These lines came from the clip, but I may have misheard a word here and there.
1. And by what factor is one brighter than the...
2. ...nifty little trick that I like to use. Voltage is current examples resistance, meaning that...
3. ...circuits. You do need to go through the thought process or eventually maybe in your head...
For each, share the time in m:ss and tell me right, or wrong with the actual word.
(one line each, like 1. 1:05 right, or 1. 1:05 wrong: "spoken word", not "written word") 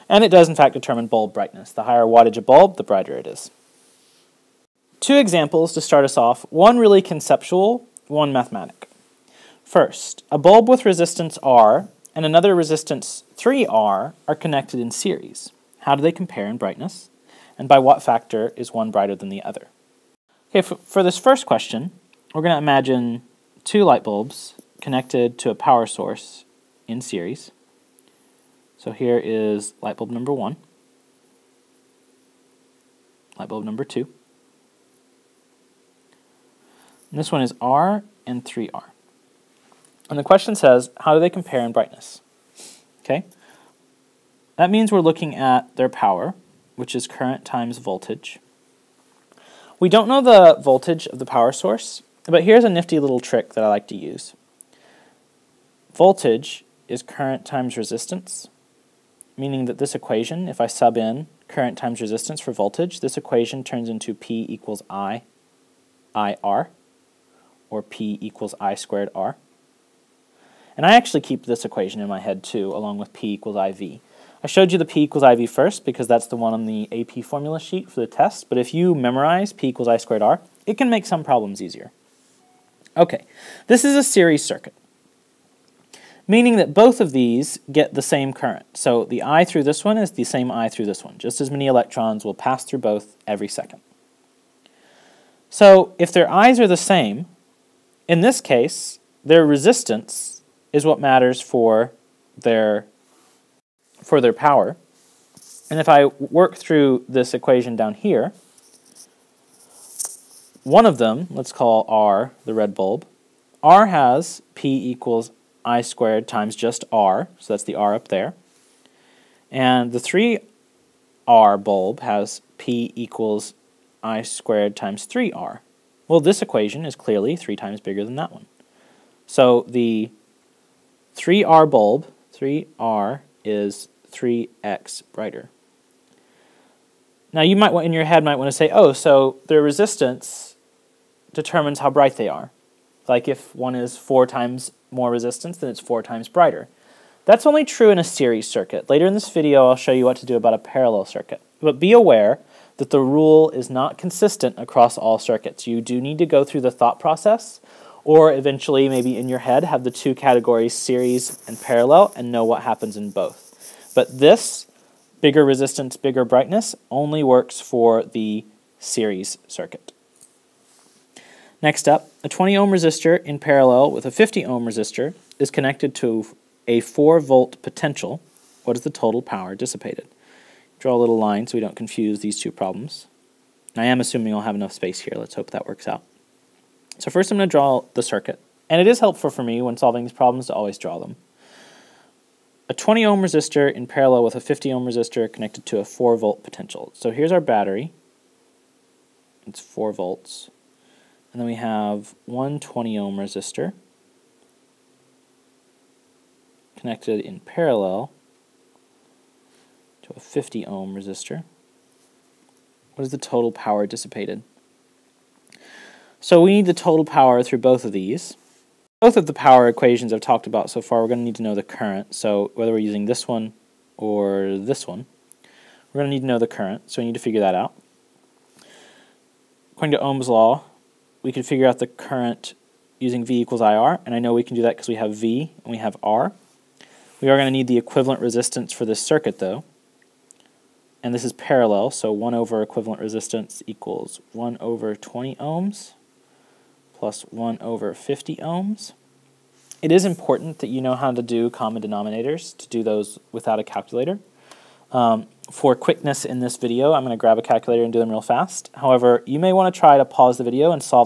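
1. 0:17 right
2. 0:52 wrong: "times", not "examples"
3. 2:35 right.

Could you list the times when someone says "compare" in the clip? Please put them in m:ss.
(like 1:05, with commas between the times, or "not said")
0:16, 0:41.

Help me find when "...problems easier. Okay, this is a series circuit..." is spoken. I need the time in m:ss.
1:21.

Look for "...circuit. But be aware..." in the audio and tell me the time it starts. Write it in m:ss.
2:31.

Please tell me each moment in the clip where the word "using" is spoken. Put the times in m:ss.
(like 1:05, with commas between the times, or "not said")
3:42, 3:52.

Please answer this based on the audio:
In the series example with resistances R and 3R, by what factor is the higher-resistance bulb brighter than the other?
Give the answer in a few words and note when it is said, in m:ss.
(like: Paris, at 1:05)
3x, at 2:14.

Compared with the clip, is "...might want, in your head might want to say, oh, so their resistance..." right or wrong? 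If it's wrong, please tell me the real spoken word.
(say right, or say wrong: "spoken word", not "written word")
right.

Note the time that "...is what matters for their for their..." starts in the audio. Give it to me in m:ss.
1:40.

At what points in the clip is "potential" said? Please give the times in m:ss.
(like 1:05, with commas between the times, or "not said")
2:57, 3:16.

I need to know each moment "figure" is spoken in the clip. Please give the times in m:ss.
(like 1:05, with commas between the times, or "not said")
3:47, 3:51.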